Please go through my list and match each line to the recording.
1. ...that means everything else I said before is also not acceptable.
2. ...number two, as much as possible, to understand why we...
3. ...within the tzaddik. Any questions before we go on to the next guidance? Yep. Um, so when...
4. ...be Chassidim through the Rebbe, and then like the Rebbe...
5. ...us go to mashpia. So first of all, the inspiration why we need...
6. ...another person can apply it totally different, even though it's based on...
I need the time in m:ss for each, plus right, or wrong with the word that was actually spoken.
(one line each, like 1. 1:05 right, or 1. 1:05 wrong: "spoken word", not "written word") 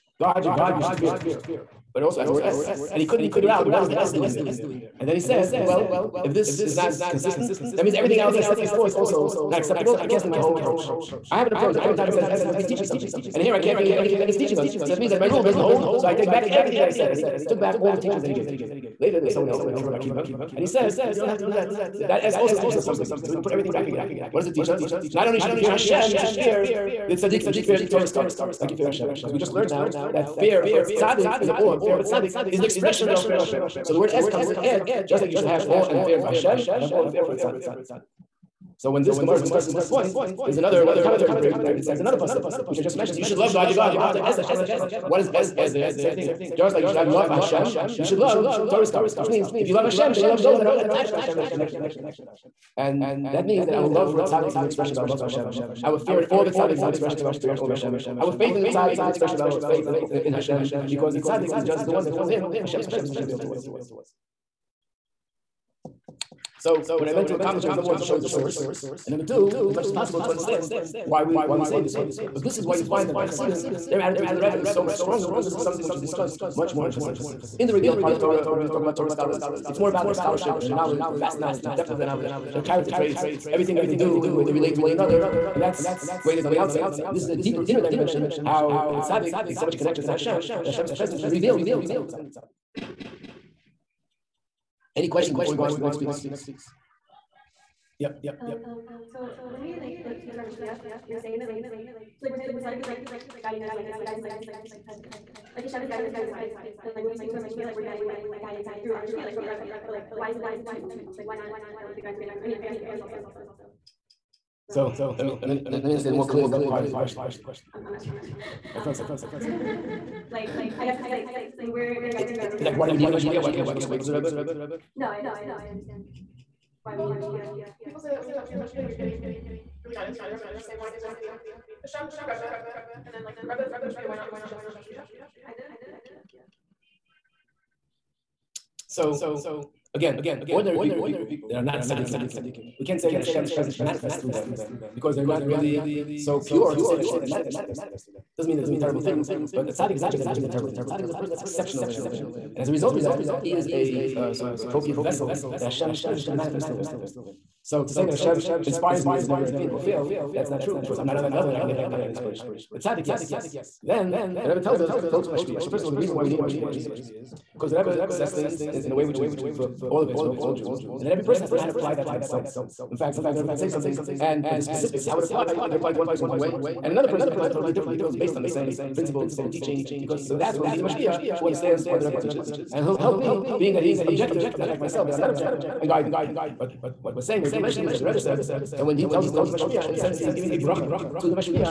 1. 0:07 right
2. 1:09 right
3. 1:31 wrong: "piece", not "guidance"
4. 2:11 wrong: "Hashem", not "Chassidim"
5. 2:44 wrong: "reason", not "inspiration"
6. 2:56 right.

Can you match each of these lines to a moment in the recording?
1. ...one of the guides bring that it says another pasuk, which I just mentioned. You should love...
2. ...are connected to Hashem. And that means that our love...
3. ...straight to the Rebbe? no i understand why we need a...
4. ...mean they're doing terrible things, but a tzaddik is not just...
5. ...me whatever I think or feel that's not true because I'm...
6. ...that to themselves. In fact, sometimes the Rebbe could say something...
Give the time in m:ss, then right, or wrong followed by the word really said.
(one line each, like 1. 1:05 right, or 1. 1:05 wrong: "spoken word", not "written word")
1. 0:40 wrong: "commentaries", not "guides"
2. 0:51 right
3. 2:03 right
4. 2:28 right
5. 2:39 right
6. 2:51 right.